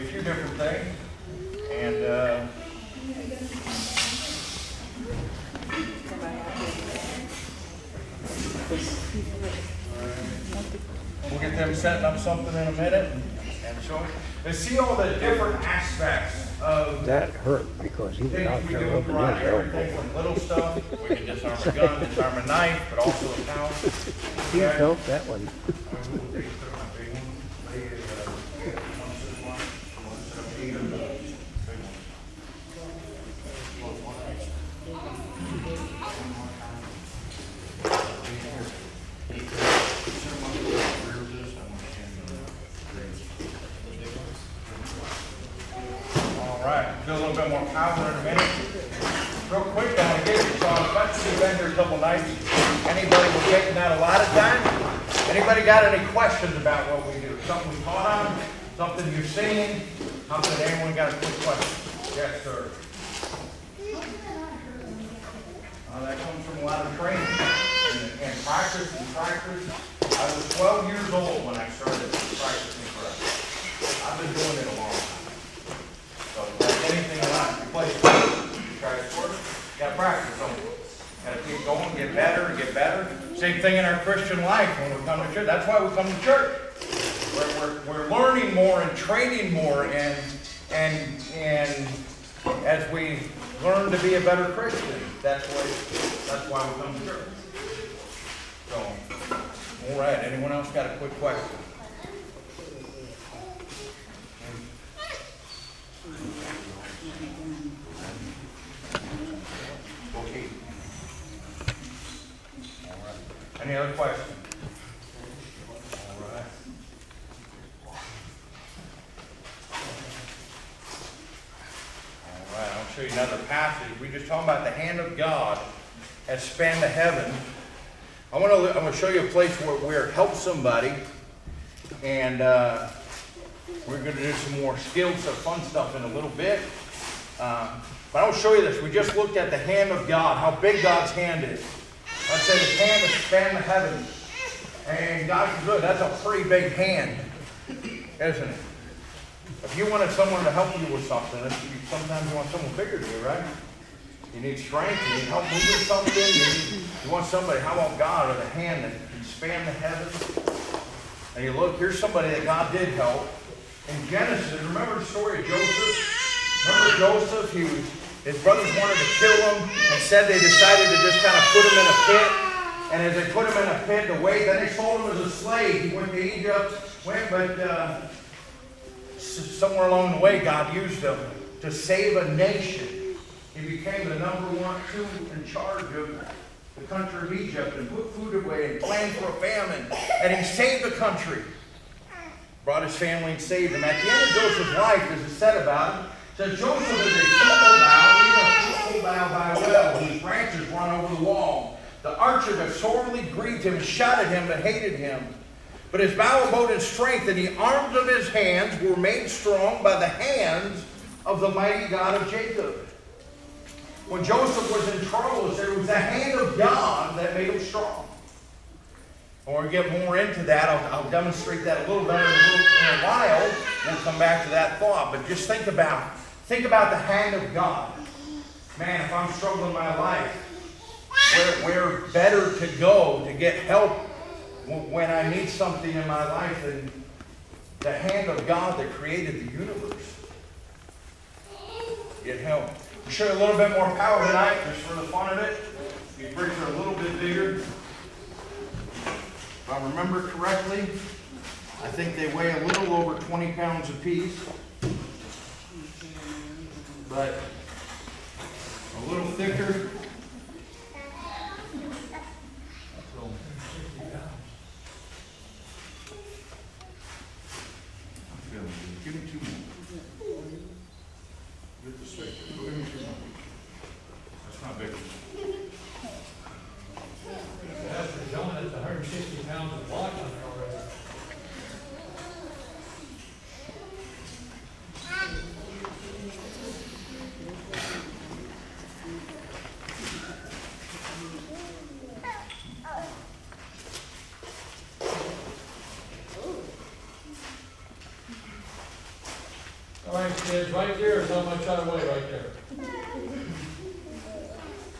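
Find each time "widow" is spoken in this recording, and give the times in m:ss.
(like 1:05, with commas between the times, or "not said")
not said.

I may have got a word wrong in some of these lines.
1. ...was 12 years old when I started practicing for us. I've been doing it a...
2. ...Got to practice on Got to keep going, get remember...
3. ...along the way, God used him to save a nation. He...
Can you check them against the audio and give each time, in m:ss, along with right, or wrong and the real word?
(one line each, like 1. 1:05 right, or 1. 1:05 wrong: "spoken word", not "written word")
1. 1:10 right
2. 1:19 wrong: "better", not "remember"
3. 2:59 right.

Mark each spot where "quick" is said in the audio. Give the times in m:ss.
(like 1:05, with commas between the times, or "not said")
0:49, 1:01, 1:40.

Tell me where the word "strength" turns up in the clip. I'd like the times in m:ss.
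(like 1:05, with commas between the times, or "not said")
2:34, 3:26.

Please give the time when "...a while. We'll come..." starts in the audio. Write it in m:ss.
3:42.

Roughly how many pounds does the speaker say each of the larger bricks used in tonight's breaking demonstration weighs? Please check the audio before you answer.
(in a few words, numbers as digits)
20 pounds.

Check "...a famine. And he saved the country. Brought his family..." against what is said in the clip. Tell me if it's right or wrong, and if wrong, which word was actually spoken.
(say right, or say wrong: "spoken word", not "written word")
right.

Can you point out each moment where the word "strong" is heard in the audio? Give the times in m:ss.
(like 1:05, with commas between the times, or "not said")
3:29, 3:37.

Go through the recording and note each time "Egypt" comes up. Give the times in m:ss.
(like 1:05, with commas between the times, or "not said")
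2:56, 3:07.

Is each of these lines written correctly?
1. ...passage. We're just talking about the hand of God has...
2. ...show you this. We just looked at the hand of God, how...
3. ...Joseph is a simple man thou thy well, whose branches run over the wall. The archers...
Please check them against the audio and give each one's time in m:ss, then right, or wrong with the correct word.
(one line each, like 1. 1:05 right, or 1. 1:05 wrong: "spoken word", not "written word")
1. 2:03 right
2. 2:18 right
3. 3:16 right.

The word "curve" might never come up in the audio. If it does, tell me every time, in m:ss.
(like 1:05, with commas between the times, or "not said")
not said.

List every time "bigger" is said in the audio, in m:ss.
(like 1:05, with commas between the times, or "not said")
2:32, 4:07.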